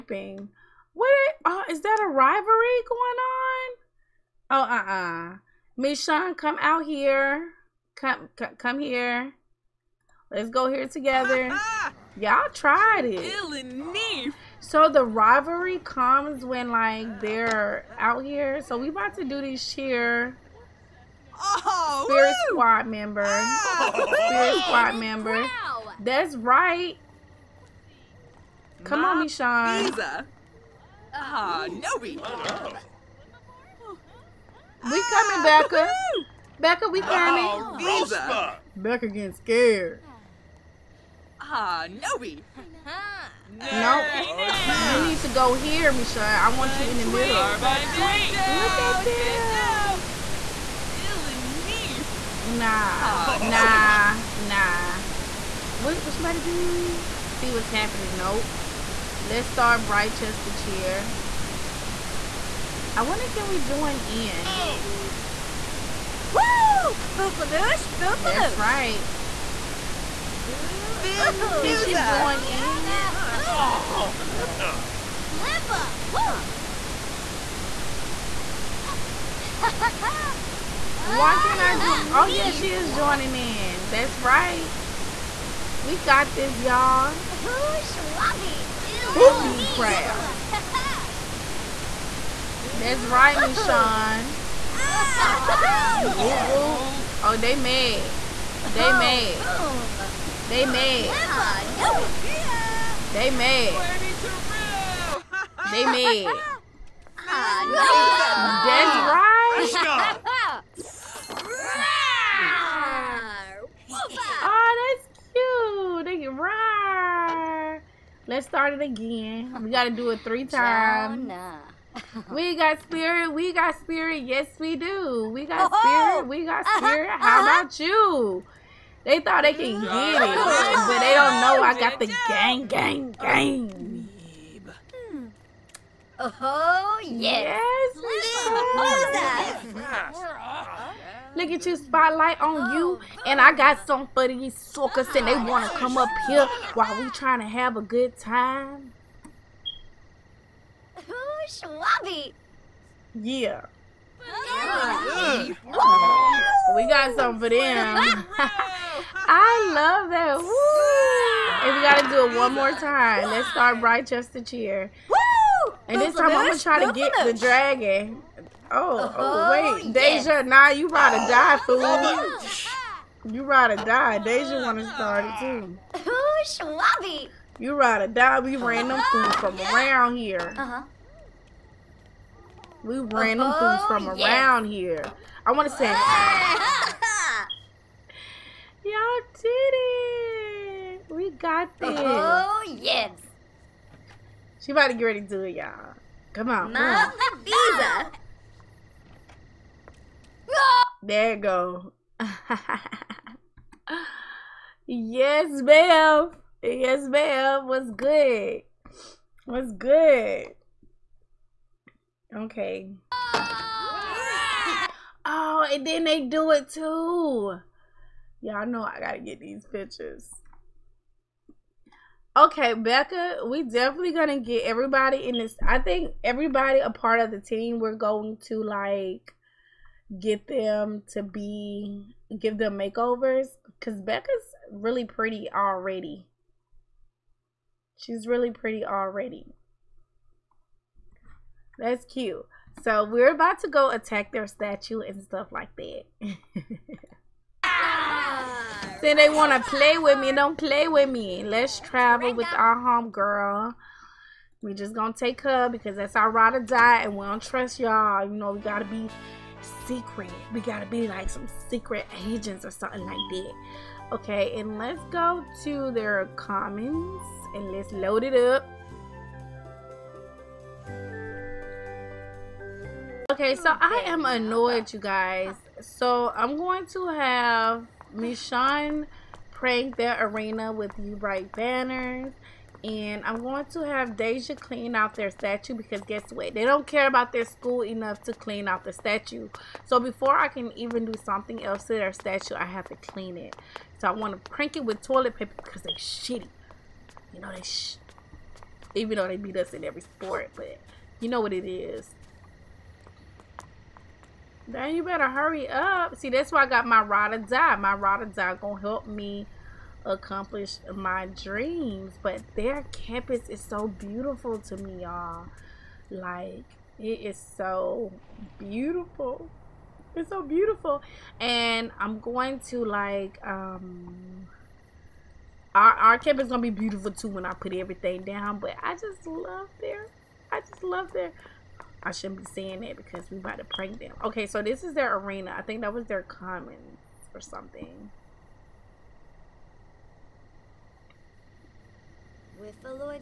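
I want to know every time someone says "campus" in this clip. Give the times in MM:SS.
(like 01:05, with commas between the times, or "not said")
05:12, 05:26.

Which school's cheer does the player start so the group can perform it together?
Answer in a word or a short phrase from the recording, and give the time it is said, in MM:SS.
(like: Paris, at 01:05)
Britechester, at 00:59.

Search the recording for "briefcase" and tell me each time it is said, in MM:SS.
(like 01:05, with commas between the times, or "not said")
not said.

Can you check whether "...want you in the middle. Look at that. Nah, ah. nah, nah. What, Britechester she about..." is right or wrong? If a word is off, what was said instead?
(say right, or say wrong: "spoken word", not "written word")
wrong: "What", not "Britechester".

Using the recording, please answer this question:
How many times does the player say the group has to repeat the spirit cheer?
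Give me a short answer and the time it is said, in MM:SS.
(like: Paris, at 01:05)
3, at 02:00.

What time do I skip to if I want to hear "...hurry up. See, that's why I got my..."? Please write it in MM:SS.
05:05.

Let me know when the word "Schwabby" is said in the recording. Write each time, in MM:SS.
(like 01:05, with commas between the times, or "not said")
01:27, 02:31, 02:56.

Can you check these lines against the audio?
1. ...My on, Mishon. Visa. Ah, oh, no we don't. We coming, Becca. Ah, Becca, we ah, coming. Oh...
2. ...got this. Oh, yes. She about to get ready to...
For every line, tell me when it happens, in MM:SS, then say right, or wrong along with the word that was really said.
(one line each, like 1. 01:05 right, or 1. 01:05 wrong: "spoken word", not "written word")
1. 00:29 right
2. 03:11 right.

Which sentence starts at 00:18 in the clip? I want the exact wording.
So we about to do this cheer.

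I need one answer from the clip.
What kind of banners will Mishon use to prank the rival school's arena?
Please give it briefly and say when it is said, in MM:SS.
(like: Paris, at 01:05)
bright banners, at 04:41.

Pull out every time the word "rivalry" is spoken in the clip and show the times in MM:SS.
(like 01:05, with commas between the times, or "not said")
00:02, 00:15.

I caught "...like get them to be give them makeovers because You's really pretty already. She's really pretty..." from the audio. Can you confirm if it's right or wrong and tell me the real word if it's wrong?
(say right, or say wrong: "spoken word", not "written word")
wrong: "Becca", not "You".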